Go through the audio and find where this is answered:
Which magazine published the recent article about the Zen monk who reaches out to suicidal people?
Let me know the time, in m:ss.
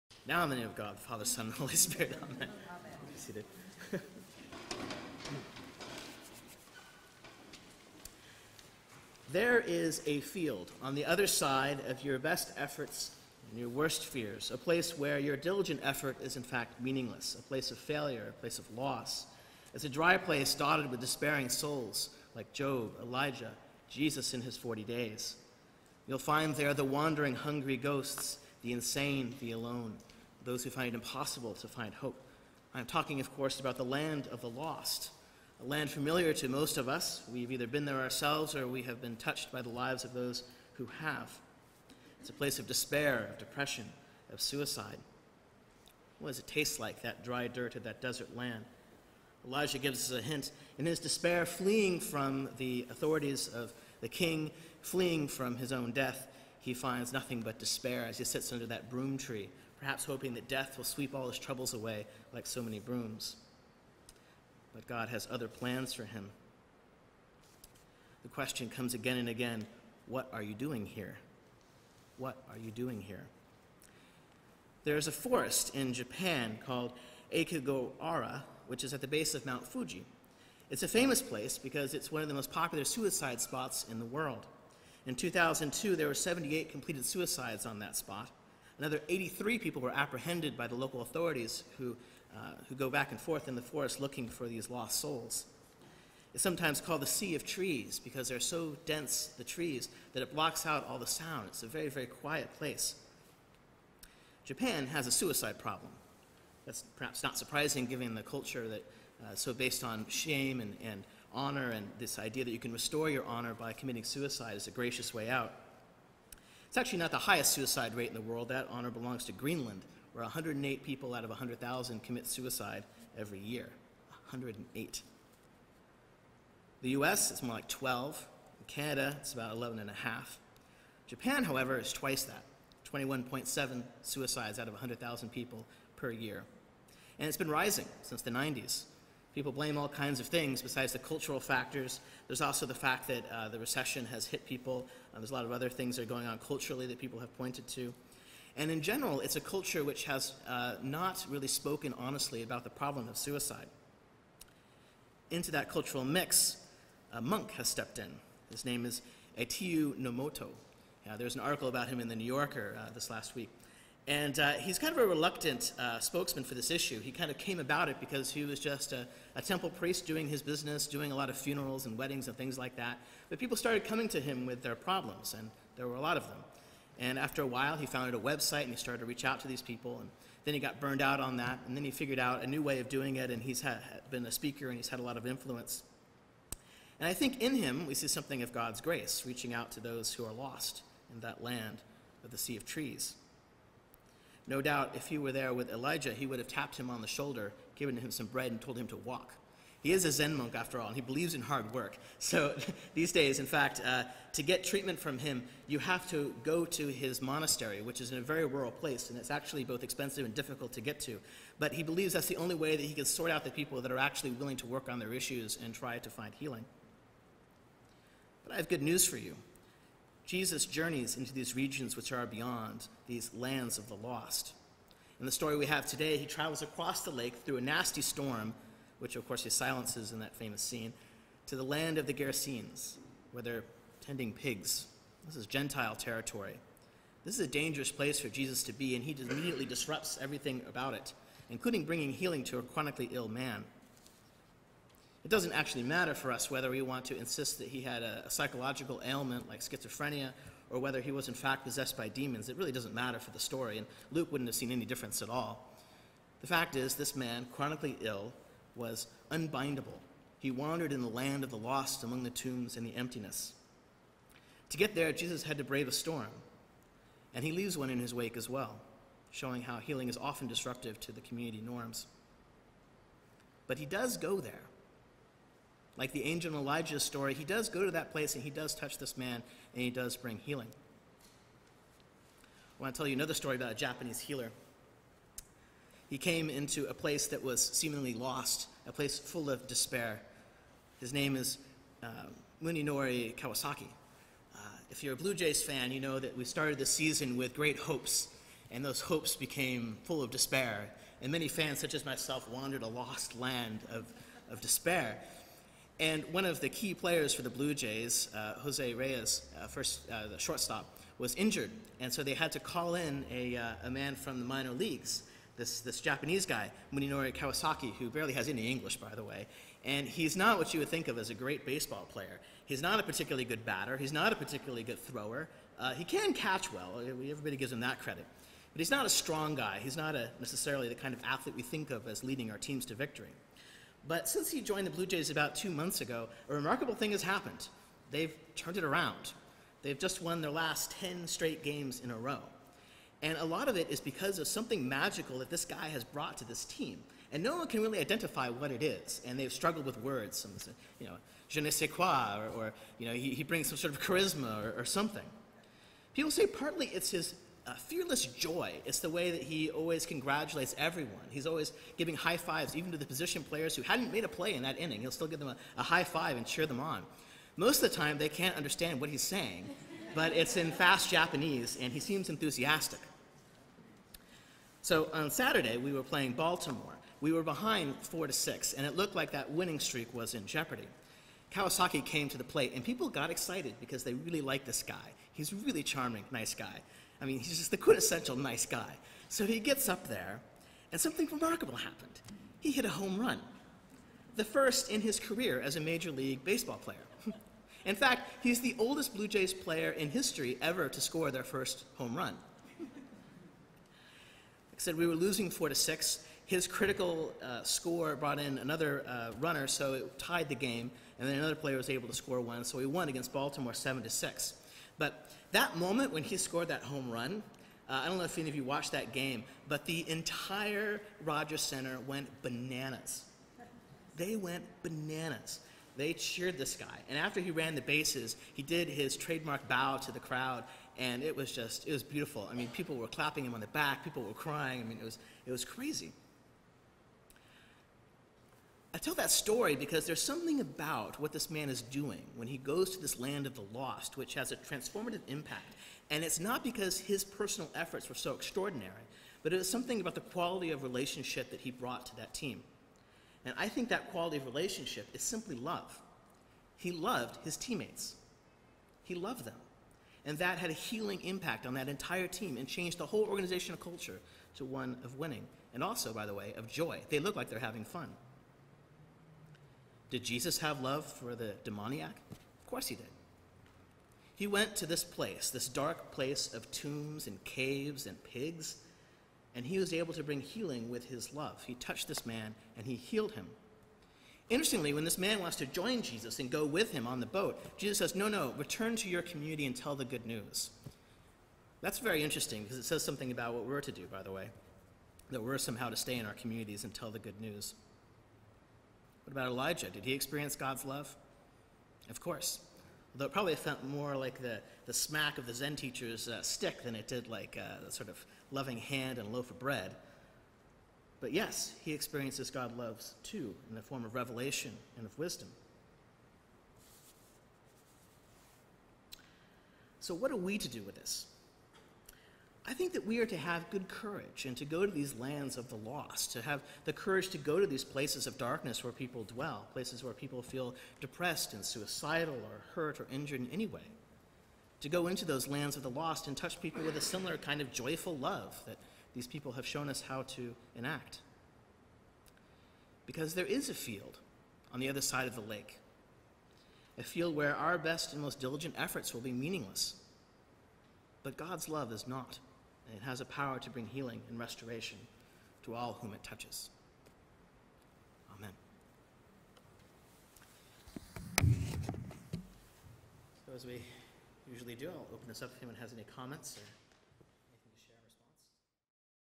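2:42.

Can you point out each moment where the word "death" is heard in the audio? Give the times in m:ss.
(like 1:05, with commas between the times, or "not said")
0:55, 1:00.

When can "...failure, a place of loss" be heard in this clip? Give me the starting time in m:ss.
0:17.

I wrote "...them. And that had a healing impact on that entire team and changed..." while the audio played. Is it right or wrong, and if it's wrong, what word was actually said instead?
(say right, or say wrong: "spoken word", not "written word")
right.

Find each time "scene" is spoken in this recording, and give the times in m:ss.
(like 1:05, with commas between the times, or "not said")
3:50.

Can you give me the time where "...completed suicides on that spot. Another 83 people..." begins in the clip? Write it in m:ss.
1:26.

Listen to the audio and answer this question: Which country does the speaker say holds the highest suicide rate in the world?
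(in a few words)
Greenland.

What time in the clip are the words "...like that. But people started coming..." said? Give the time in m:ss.
2:52.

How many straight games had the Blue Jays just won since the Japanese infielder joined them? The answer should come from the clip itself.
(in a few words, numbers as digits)
10.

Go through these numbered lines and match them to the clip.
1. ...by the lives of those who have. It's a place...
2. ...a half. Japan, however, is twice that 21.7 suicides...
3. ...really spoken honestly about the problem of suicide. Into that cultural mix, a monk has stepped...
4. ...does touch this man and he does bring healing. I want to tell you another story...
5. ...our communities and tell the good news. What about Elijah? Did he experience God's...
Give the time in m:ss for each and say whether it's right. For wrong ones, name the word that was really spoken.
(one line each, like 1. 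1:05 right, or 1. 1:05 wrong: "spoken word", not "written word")
1. 0:39 right
2. 2:09 right
3. 2:31 right
4. 4:38 right
5. 8:16 right.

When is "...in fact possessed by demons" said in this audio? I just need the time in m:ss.
4:11.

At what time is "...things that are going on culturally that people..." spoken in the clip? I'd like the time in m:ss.
2:25.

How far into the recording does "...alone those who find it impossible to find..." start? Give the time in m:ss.
0:29.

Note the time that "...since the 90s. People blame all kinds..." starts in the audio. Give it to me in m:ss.
2:18.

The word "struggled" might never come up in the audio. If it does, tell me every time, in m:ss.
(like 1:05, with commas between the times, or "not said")
5:49.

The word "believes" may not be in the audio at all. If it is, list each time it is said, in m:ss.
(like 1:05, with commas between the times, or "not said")
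3:21, 3:31.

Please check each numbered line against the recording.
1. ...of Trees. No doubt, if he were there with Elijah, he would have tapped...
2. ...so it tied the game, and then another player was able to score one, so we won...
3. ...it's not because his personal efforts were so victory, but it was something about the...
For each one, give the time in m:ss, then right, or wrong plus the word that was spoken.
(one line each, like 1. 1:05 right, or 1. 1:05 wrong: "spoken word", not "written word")
1. 3:12 right
2. 6:49 right
3. 7:26 wrong: "extraordinary", not "victory".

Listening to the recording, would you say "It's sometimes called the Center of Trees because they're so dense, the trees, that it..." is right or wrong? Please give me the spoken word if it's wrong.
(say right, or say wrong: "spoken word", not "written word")
wrong: "Sea", not "Center".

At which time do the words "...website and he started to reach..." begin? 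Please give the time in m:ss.
2:58.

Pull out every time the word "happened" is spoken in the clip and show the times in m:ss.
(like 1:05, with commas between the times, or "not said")
5:37, 6:31.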